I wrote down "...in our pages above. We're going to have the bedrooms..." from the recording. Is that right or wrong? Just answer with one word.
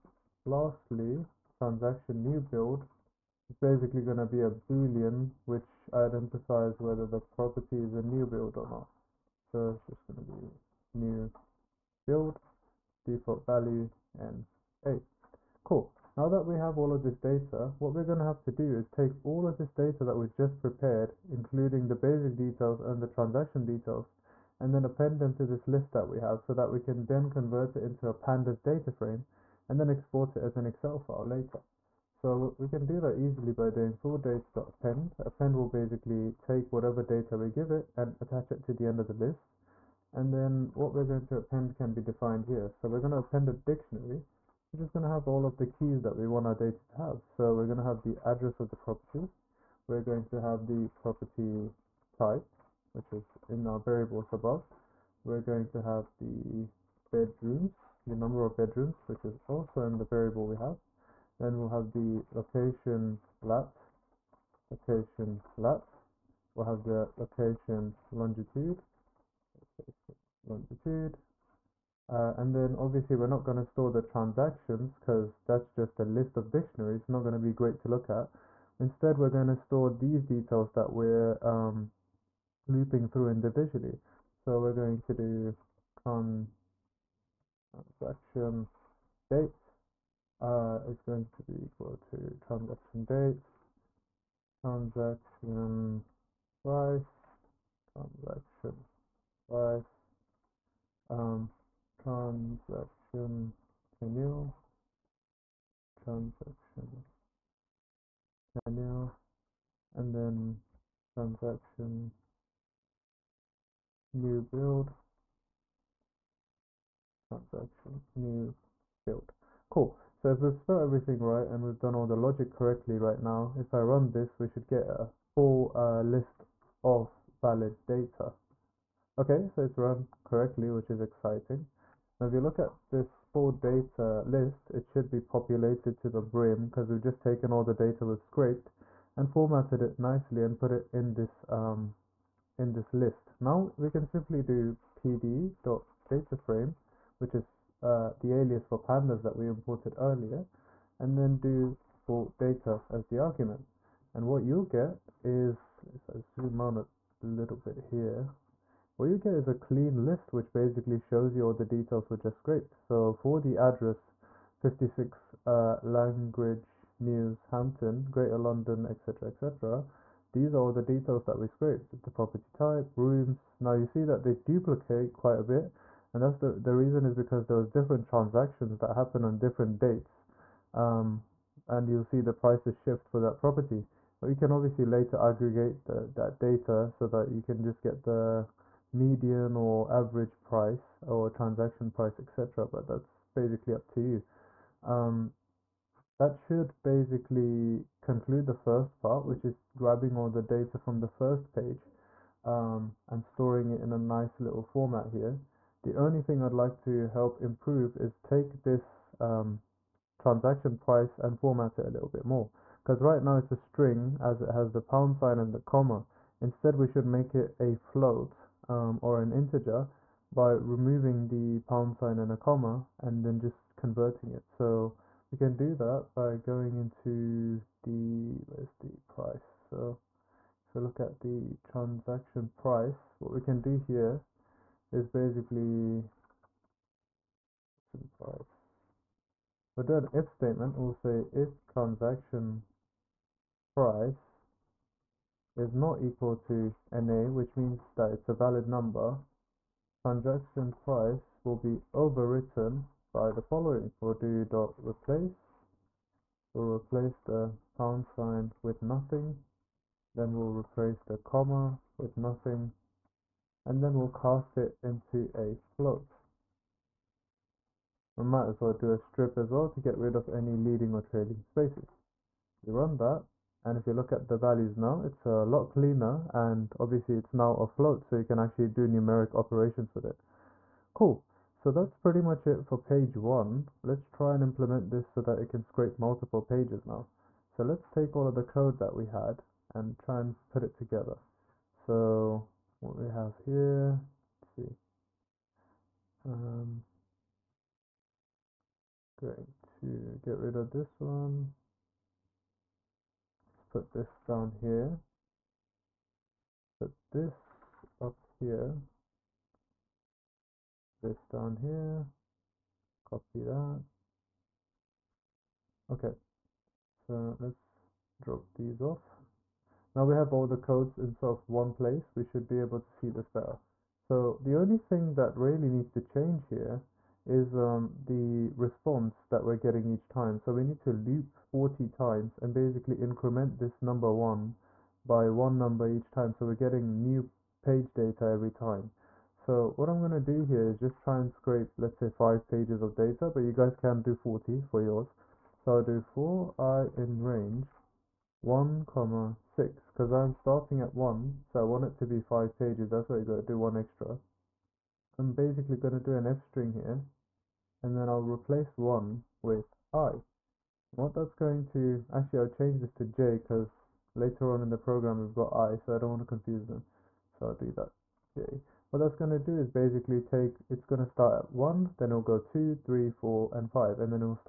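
wrong.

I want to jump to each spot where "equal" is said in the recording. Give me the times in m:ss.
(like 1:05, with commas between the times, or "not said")
1:31, 4:06.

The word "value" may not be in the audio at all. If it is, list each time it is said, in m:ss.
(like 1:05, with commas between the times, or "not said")
0:13, 4:34.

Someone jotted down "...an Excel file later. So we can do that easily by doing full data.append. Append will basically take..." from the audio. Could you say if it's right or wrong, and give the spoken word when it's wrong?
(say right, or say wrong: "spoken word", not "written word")
right.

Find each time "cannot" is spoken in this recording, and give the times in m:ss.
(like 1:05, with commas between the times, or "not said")
not said.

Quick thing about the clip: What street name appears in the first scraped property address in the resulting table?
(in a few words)
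Langridge Mews.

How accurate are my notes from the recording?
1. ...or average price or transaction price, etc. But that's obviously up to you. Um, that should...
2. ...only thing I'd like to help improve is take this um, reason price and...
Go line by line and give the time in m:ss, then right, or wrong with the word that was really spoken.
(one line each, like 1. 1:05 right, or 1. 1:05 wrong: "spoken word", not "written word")
1. 3:09 wrong: "basically", not "obviously"
2. 3:25 wrong: "transaction", not "reason".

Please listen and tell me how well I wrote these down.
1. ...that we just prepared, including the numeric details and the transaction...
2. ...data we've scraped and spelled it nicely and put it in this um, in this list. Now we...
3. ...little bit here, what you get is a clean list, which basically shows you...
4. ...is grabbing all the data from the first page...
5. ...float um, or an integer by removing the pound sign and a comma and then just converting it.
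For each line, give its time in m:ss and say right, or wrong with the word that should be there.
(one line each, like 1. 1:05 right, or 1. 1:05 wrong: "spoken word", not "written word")
1. 0:20 wrong: "basic", not "numeric"
2. 2:17 wrong: "formatted", not "spelled"
3. 2:37 right
4. 3:19 right
5. 3:37 right.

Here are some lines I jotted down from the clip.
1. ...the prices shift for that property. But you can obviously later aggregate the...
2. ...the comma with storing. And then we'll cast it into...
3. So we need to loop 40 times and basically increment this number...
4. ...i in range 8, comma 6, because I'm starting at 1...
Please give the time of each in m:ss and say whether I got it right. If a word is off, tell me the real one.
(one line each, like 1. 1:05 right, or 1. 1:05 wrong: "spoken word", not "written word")
1. 3:02 right
2. 4:21 wrong: "nothing", not "storing"
3. 5:30 right
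4. 5:46 wrong: "1", not "8".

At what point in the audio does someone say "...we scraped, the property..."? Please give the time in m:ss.
2:51.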